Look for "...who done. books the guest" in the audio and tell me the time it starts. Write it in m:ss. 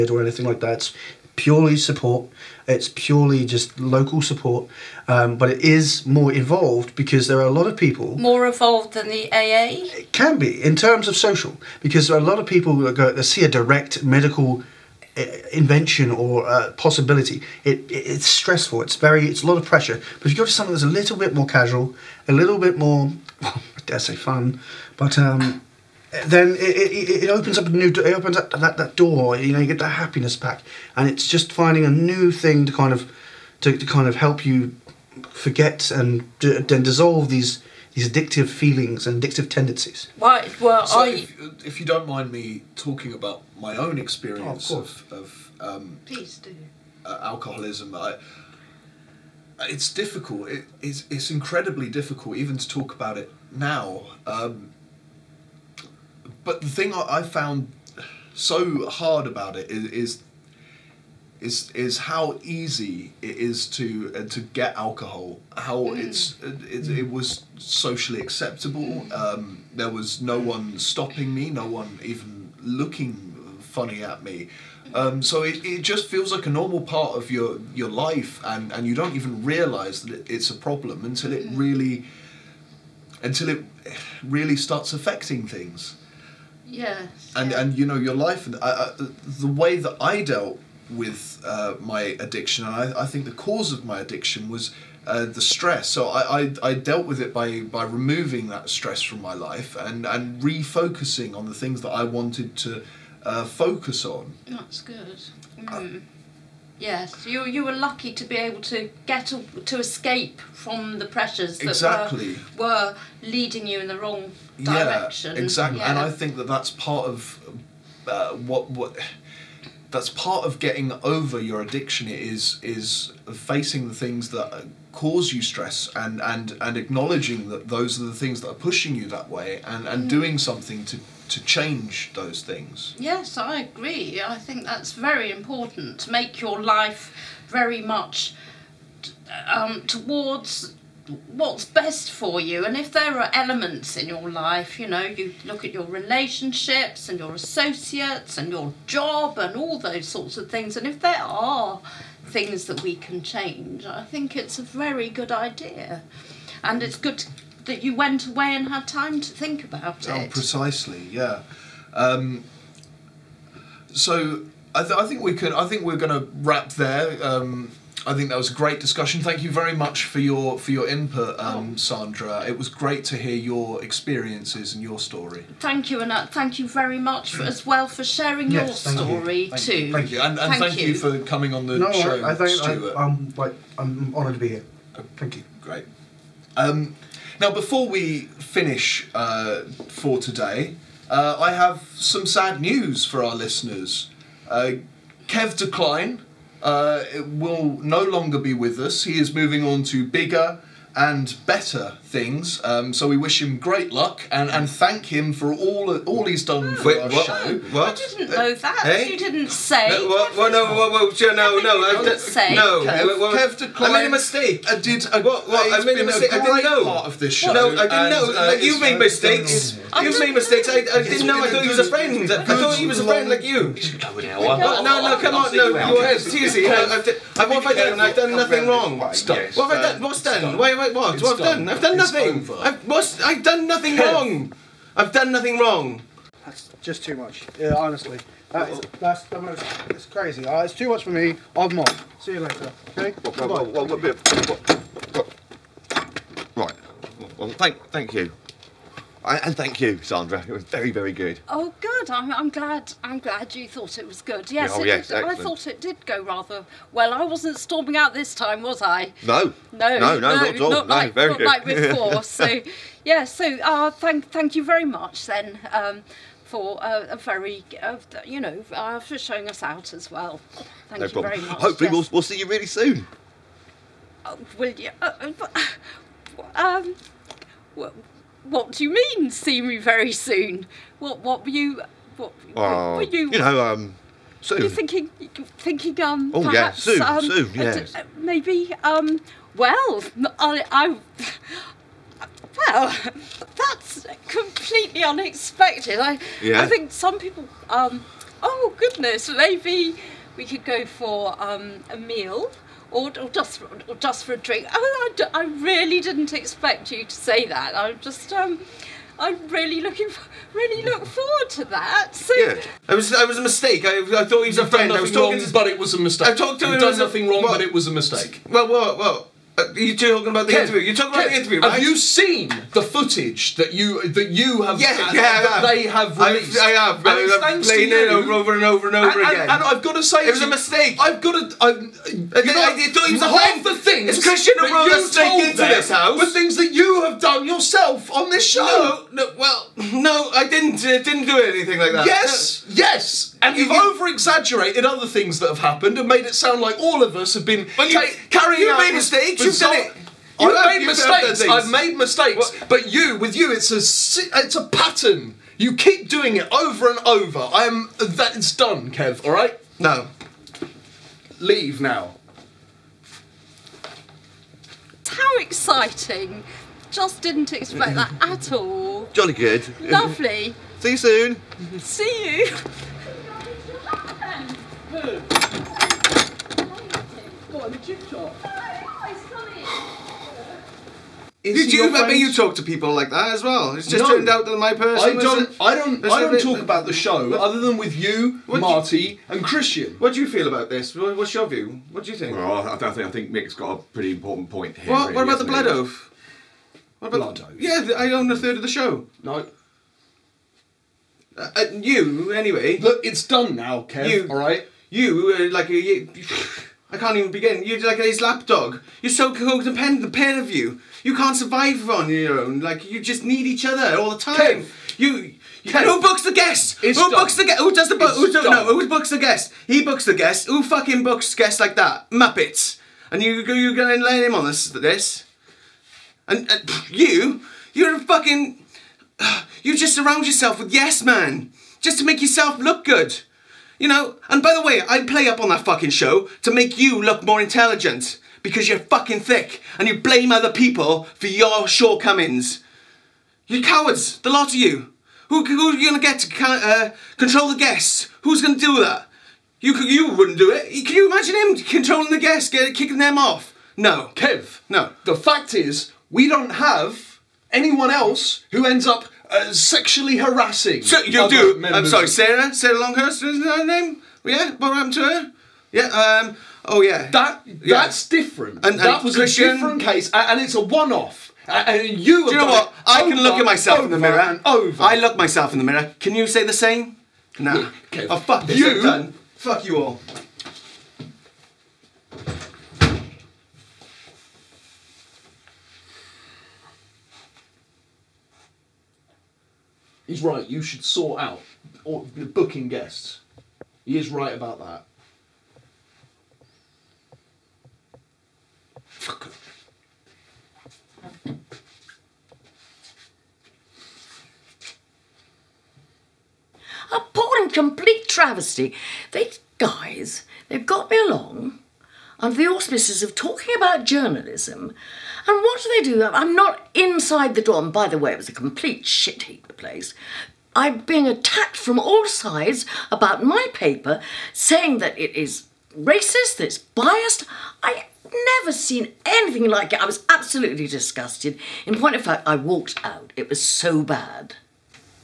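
6:56.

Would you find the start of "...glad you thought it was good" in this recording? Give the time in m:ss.
4:13.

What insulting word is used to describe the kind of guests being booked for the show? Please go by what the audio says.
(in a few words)
Muppets.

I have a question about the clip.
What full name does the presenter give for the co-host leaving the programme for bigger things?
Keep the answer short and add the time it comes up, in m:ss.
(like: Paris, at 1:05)
Kev Decline, at 3:15.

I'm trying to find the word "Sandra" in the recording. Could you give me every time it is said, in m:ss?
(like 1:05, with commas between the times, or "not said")
2:51, 4:10.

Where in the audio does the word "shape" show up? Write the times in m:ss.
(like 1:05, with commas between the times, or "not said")
not said.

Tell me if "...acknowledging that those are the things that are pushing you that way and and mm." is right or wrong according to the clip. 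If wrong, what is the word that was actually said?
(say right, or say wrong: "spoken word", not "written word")
right.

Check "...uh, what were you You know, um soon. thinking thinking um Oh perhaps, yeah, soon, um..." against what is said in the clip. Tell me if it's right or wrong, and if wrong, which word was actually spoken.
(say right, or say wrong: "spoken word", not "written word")
right.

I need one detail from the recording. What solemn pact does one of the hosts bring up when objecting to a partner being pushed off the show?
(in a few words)
The blood oath.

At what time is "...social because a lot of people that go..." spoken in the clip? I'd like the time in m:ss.
0:11.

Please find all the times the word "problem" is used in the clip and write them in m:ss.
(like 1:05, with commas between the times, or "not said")
1:20, 4:31.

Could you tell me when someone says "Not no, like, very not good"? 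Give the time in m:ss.
4:20.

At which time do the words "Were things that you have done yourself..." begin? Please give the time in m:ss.
5:36.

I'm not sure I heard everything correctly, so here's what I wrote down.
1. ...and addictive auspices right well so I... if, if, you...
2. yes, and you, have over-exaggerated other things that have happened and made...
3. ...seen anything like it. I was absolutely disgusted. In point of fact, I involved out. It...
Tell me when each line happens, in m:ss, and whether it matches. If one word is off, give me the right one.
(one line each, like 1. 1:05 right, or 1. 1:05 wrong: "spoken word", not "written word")
1. 0:39 wrong: "tendencies", not "auspices"
2. 5:42 right
3. 8:48 wrong: "walked", not "involved".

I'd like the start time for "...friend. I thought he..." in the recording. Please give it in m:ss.
3:41.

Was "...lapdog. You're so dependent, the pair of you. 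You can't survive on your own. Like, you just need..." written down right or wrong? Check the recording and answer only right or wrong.
right.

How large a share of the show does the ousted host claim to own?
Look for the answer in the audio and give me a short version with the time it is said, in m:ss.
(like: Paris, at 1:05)
A third, at 6:38.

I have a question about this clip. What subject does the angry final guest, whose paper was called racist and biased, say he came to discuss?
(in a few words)
Journalism.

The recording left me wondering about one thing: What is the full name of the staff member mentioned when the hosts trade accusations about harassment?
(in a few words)
Sarah Longhurst.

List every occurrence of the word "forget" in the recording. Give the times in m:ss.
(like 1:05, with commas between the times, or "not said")
0:35.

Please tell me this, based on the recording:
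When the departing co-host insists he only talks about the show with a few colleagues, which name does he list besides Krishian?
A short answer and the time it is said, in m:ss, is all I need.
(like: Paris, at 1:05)
Marty, at 6:28.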